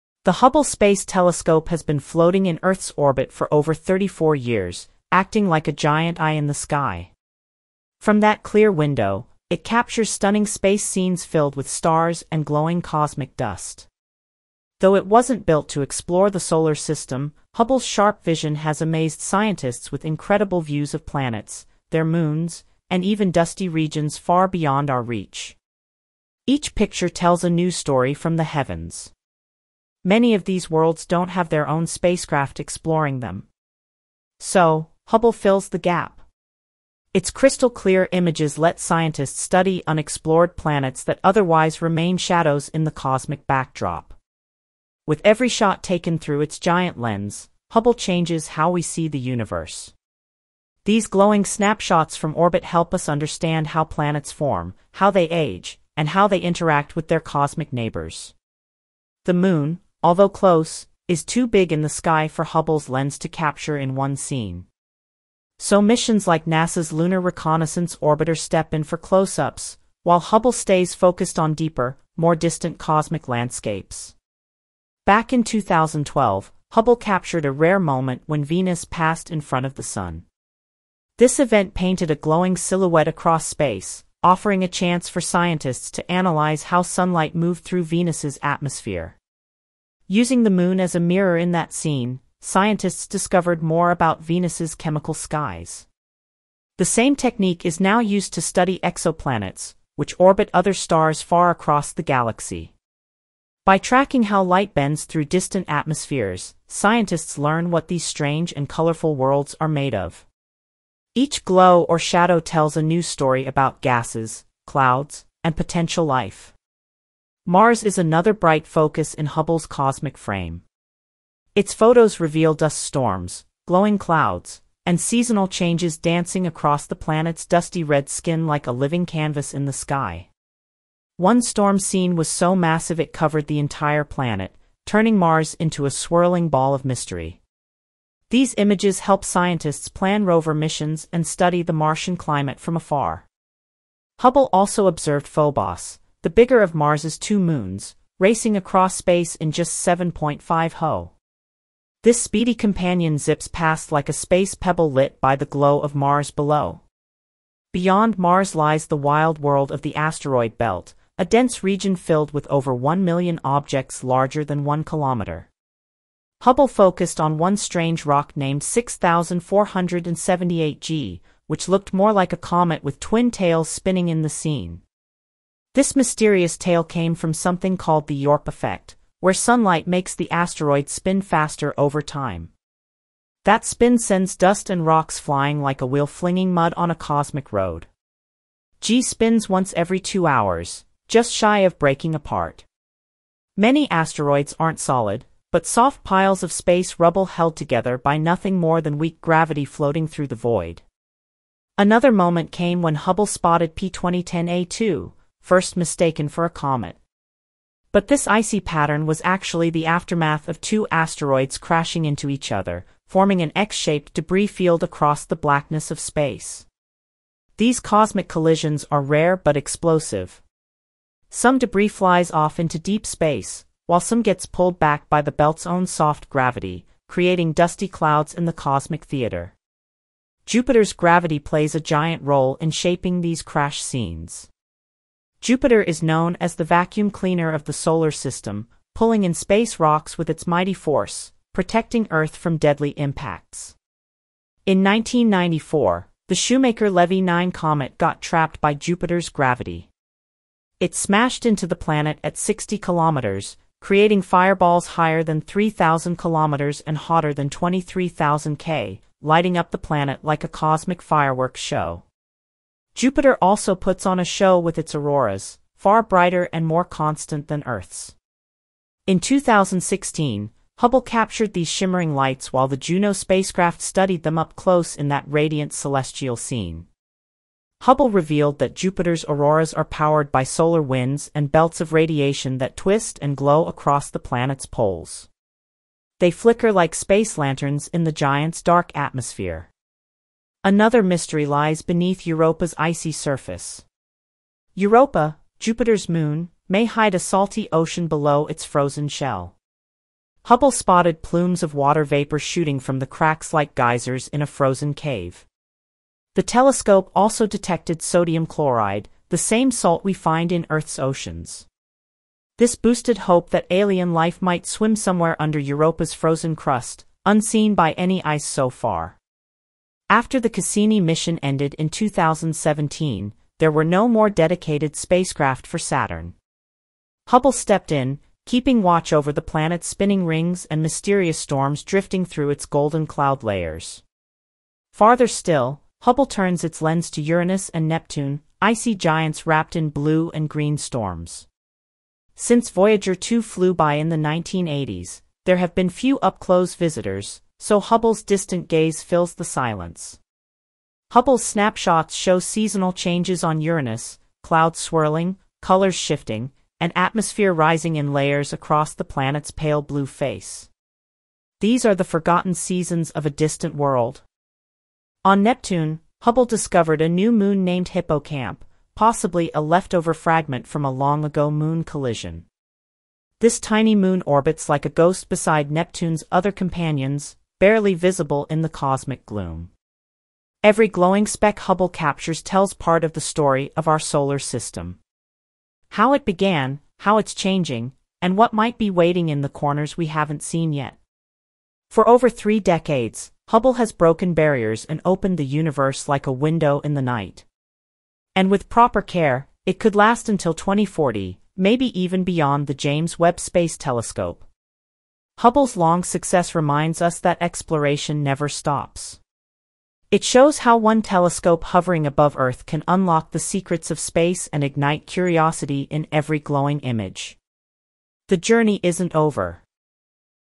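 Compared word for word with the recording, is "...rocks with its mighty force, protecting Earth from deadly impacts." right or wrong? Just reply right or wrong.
right.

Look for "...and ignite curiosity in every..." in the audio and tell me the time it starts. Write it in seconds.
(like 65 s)
414 s.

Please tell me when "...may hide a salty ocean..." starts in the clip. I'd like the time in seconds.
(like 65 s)
296 s.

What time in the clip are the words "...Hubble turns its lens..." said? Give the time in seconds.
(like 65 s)
336 s.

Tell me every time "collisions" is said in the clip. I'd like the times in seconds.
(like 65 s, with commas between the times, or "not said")
218 s, 371 s.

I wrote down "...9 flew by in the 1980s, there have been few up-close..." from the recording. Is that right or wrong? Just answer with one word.
wrong.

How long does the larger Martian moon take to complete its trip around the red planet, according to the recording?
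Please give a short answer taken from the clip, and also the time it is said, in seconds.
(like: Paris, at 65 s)
7.5 hours, at 149 s.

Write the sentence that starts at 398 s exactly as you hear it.
And with proper care, it could last until 2040, maybe even beyond the James Webb Space Telescope.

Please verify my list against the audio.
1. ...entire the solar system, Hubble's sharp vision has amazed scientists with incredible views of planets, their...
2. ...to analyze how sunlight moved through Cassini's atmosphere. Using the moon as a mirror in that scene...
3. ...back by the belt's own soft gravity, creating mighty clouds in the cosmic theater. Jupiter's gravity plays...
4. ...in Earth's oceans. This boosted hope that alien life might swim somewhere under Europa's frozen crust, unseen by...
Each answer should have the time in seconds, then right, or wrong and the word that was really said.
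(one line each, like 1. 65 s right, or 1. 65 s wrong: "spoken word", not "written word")
1. 15 s wrong: "explore", not "entire"
2. 85 s wrong: "Venus", not "Cassini"
3. 224 s wrong: "dusty", not "mighty"
4. 310 s right.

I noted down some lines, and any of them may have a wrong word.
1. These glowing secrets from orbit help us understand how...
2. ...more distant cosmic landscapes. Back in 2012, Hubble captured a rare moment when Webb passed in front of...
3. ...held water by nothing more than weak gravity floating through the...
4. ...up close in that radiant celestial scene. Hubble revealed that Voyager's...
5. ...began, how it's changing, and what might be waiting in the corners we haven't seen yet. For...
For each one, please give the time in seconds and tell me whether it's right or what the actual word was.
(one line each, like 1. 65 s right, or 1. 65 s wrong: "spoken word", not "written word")
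1. 50 s wrong: "snapshots", not "secrets"
2. 72 s wrong: "Venus", not "Webb"
3. 197 s wrong: "together", not "water"
4. 274 s wrong: "Jupiter", not "Voyager"
5. 386 s right.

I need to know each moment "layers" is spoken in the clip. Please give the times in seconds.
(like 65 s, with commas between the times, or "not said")
333 s, 358 s.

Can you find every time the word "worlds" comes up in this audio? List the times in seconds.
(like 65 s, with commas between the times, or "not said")
30 s, 109 s, 159 s, 363 s.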